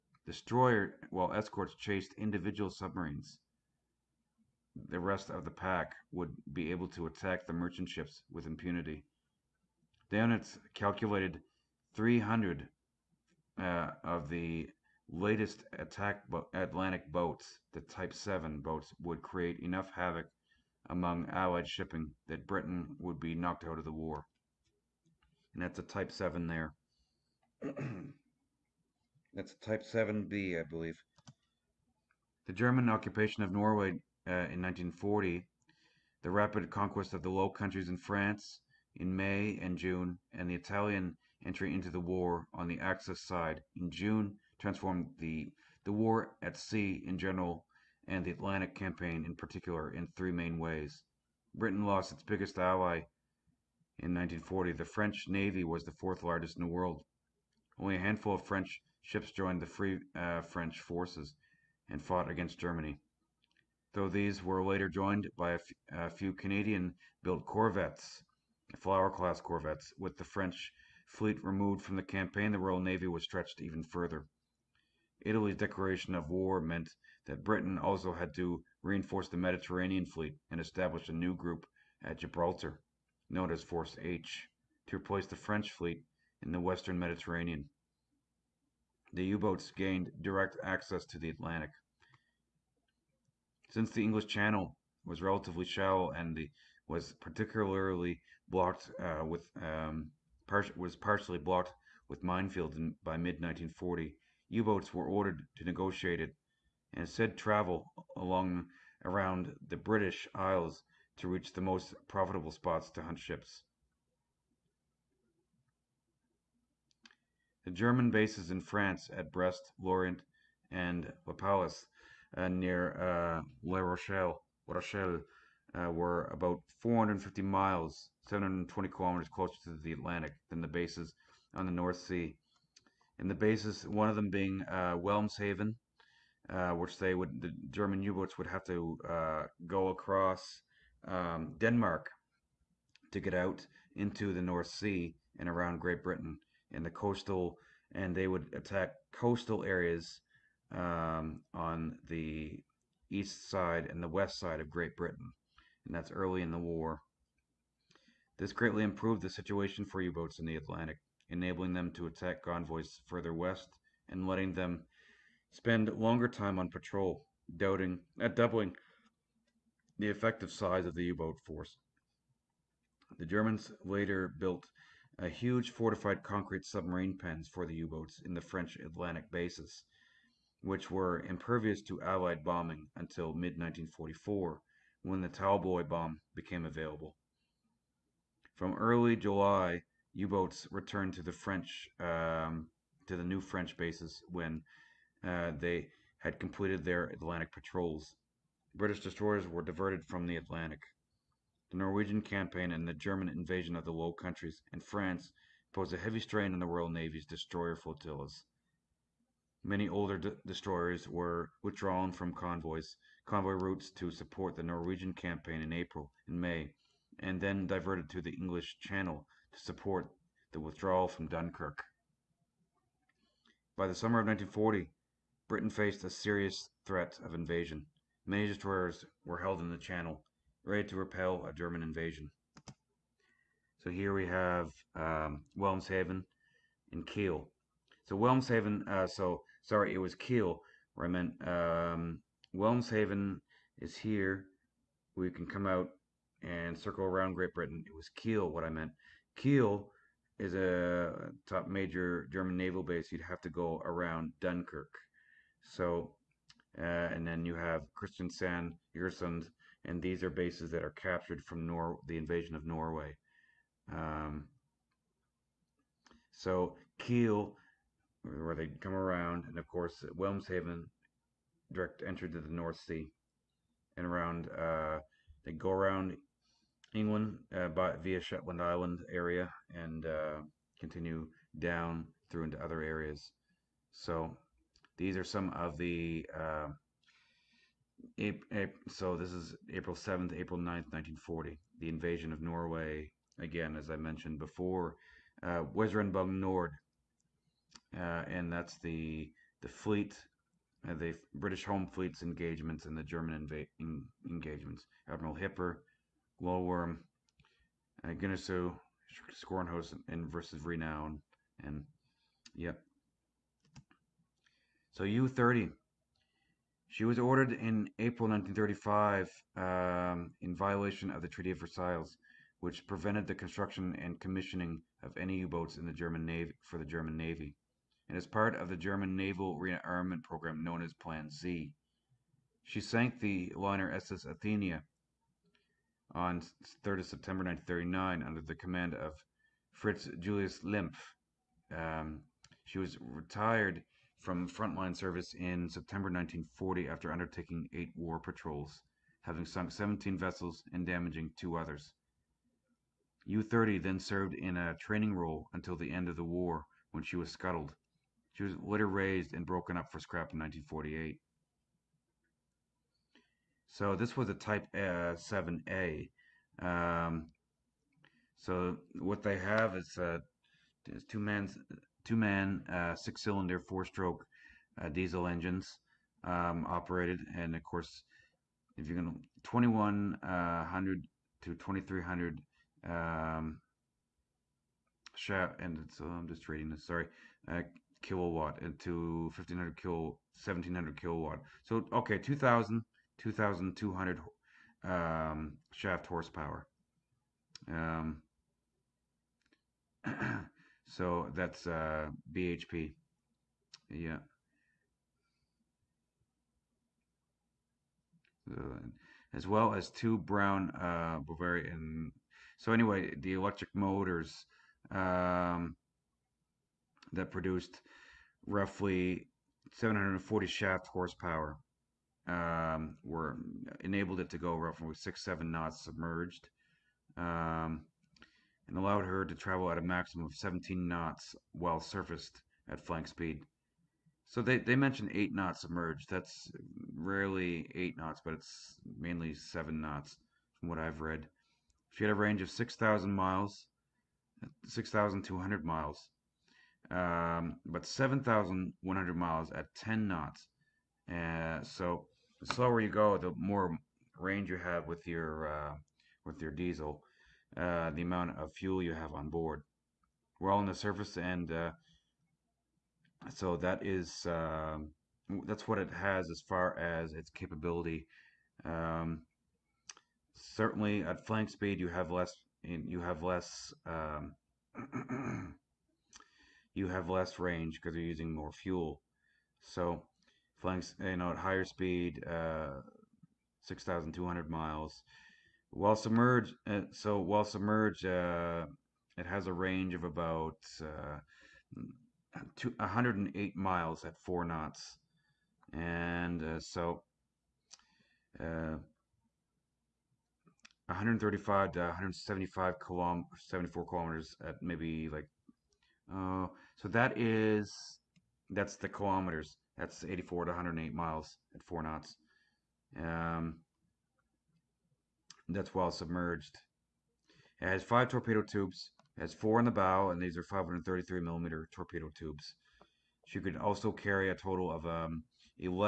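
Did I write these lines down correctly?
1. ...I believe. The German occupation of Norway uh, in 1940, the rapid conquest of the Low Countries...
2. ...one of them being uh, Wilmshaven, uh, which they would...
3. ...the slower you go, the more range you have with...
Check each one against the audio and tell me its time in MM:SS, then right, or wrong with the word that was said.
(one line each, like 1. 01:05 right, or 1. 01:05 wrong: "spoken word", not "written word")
1. 00:30 right
2. 02:13 right
3. 07:32 right.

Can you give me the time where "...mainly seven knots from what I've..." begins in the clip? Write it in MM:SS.
07:18.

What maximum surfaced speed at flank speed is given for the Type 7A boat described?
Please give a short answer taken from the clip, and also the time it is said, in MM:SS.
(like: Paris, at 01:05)
17 knots, at 07:10.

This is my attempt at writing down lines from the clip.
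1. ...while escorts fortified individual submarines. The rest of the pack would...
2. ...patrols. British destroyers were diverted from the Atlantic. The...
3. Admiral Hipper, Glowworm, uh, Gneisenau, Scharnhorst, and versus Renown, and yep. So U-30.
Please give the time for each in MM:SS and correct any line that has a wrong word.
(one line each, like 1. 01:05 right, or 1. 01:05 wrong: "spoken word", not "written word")
1. 00:01 wrong: "chased", not "fortified"
2. 03:17 right
3. 05:05 right.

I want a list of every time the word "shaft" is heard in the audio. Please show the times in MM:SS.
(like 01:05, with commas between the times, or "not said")
06:25, 06:35, 07:00.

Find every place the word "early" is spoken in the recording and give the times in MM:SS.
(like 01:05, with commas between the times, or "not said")
02:36, 03:08.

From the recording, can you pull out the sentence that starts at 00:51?
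Britain lost its biggest ally in 1940.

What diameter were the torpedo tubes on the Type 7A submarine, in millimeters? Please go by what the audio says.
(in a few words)
533 millimeters.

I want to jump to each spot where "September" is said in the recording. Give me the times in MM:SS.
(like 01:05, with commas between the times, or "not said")
05:37, 05:45.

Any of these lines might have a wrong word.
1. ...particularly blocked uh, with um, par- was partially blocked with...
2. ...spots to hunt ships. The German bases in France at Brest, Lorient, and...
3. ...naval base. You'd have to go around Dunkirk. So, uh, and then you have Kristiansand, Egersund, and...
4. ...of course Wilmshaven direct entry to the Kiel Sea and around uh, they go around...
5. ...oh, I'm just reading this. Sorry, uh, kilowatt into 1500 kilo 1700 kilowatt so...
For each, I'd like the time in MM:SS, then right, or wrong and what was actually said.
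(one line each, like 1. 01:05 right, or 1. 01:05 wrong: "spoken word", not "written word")
1. 01:37 right
2. 01:52 right
3. 04:12 right
4. 04:29 wrong: "North", not "Kiel"
5. 06:26 right.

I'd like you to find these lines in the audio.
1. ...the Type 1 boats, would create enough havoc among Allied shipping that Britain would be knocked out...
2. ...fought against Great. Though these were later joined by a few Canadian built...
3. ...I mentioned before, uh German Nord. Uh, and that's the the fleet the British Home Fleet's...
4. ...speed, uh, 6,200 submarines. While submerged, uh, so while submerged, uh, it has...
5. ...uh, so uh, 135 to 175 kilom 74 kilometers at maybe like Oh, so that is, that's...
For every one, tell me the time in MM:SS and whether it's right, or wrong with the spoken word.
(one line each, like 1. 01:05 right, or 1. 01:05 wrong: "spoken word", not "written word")
1. 00:17 wrong: "7", not "1"
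2. 01:02 wrong: "Germany", not "Great"
3. 04:53 wrong: "Weserübung", not "German"
4. 08:01 wrong: "miles", not "submarines"
5. 08:16 right.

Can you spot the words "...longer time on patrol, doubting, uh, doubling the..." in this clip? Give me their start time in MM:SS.
02:45.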